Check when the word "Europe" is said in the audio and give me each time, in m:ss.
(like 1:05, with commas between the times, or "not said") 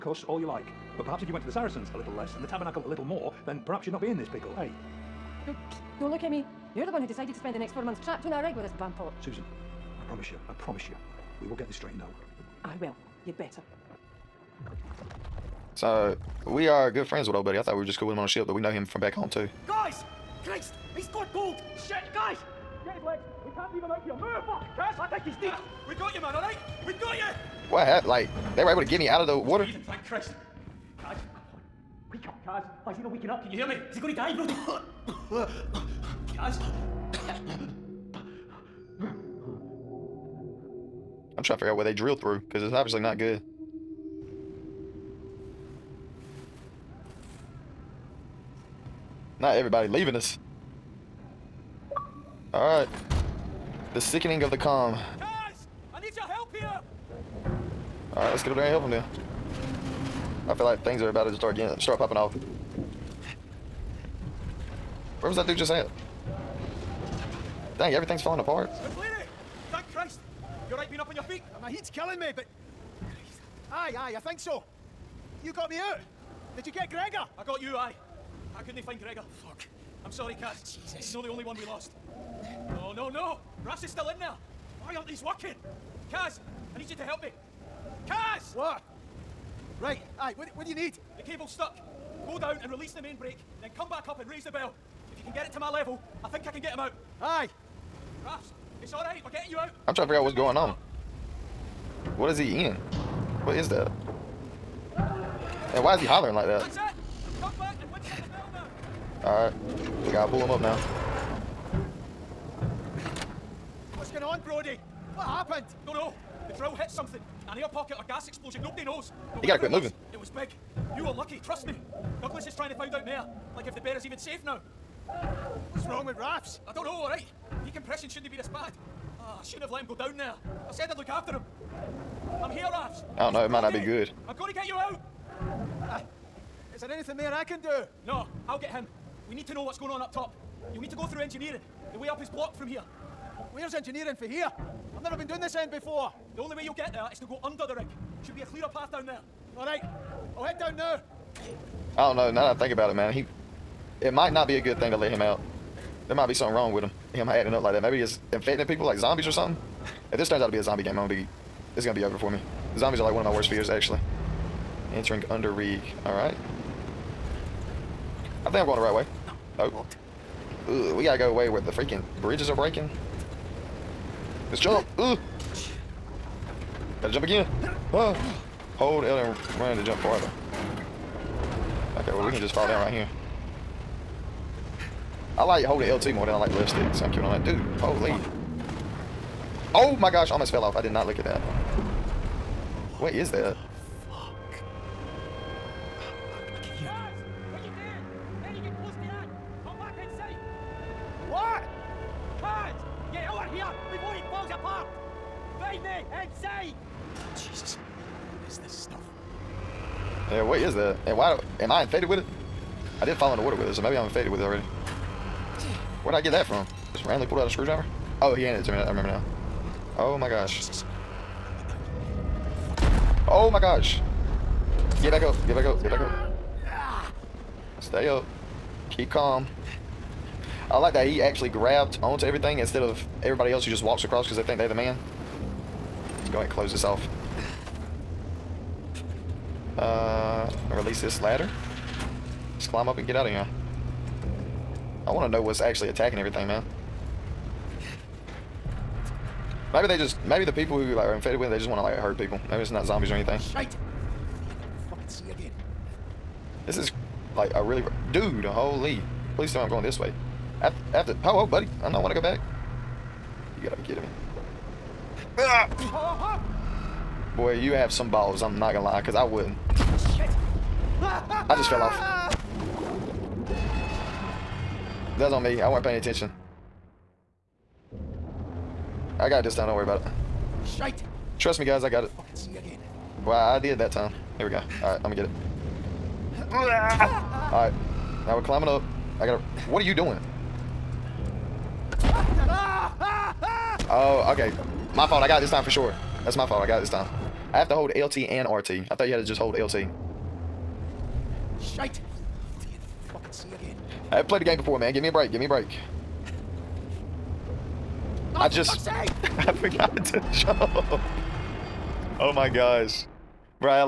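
not said.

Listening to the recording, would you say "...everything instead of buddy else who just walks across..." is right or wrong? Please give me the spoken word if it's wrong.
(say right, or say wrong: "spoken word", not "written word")
wrong: "everybody", not "buddy".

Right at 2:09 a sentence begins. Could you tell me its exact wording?
Oh, I shouldn't have let him go down there.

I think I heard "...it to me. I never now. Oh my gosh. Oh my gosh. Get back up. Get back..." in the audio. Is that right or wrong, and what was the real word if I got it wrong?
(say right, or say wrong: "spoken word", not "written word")
wrong: "remember", not "never".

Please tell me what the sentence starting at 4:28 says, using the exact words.
I'm not gonna lie, cause I wouldn't.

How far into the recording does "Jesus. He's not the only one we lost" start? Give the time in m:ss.
1:20.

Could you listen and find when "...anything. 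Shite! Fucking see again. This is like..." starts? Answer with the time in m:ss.
4:13.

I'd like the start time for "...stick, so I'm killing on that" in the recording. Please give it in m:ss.
3:06.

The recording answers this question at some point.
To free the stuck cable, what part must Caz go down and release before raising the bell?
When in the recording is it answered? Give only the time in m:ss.
1:33.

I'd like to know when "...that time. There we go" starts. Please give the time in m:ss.
4:43.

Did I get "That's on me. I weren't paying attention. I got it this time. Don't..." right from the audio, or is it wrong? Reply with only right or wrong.
right.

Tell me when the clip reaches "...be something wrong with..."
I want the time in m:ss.
2:36.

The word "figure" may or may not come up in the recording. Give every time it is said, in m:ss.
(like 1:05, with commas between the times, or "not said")
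0:41, 1:40.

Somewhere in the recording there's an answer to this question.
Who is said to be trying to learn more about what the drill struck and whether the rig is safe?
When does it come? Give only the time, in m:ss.
2:02.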